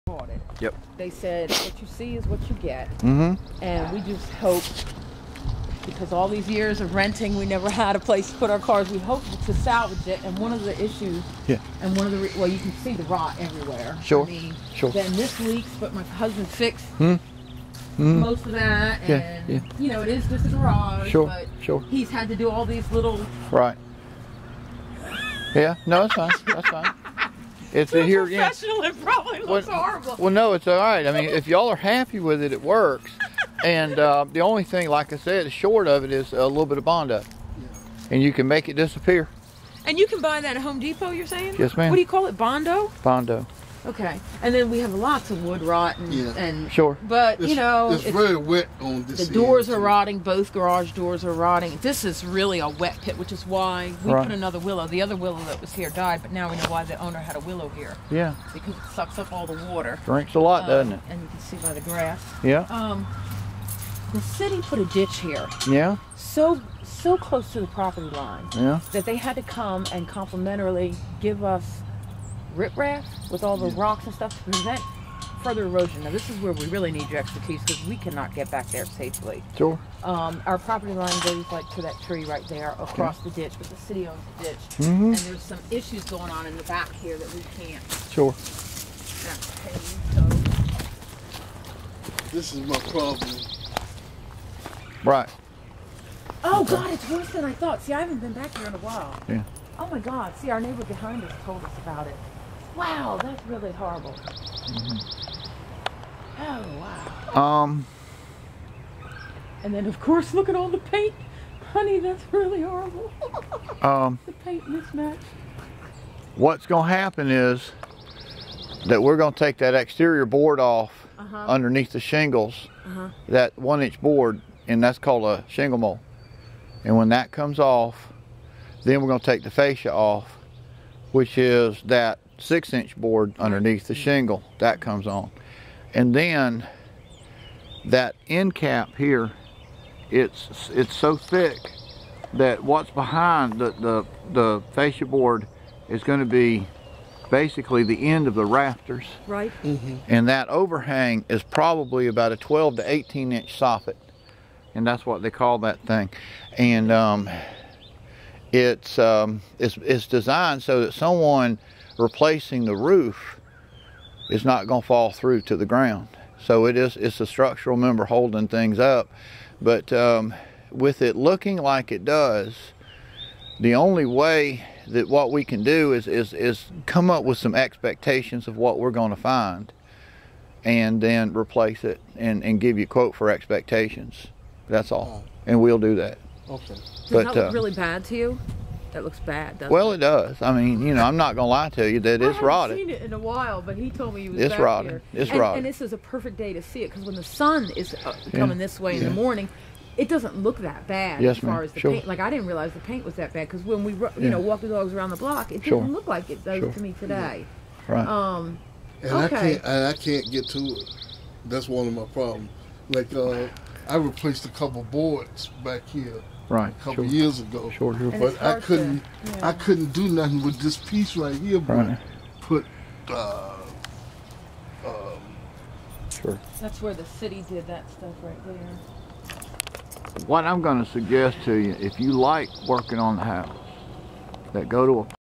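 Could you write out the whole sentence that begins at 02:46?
So it is, it's a structural member holding things up.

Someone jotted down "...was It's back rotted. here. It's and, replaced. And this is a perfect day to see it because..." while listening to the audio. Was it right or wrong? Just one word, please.
wrong.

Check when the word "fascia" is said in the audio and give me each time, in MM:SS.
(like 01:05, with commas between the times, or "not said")
02:09, 02:24.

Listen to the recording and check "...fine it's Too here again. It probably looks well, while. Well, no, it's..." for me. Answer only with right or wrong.
wrong.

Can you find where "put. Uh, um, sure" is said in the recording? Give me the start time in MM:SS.
03:42.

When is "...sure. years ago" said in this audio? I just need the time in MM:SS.
03:37.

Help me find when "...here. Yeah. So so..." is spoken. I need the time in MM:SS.
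01:05.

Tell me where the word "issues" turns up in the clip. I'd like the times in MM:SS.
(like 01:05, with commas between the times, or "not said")
00:10, 01:25.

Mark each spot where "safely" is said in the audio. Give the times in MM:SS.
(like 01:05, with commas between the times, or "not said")
01:18.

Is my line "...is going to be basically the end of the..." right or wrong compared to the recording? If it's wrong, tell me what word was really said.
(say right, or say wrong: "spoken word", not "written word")
right.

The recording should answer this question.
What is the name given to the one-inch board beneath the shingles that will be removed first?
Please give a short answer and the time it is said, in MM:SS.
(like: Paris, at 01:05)
shingle mold, at 02:05.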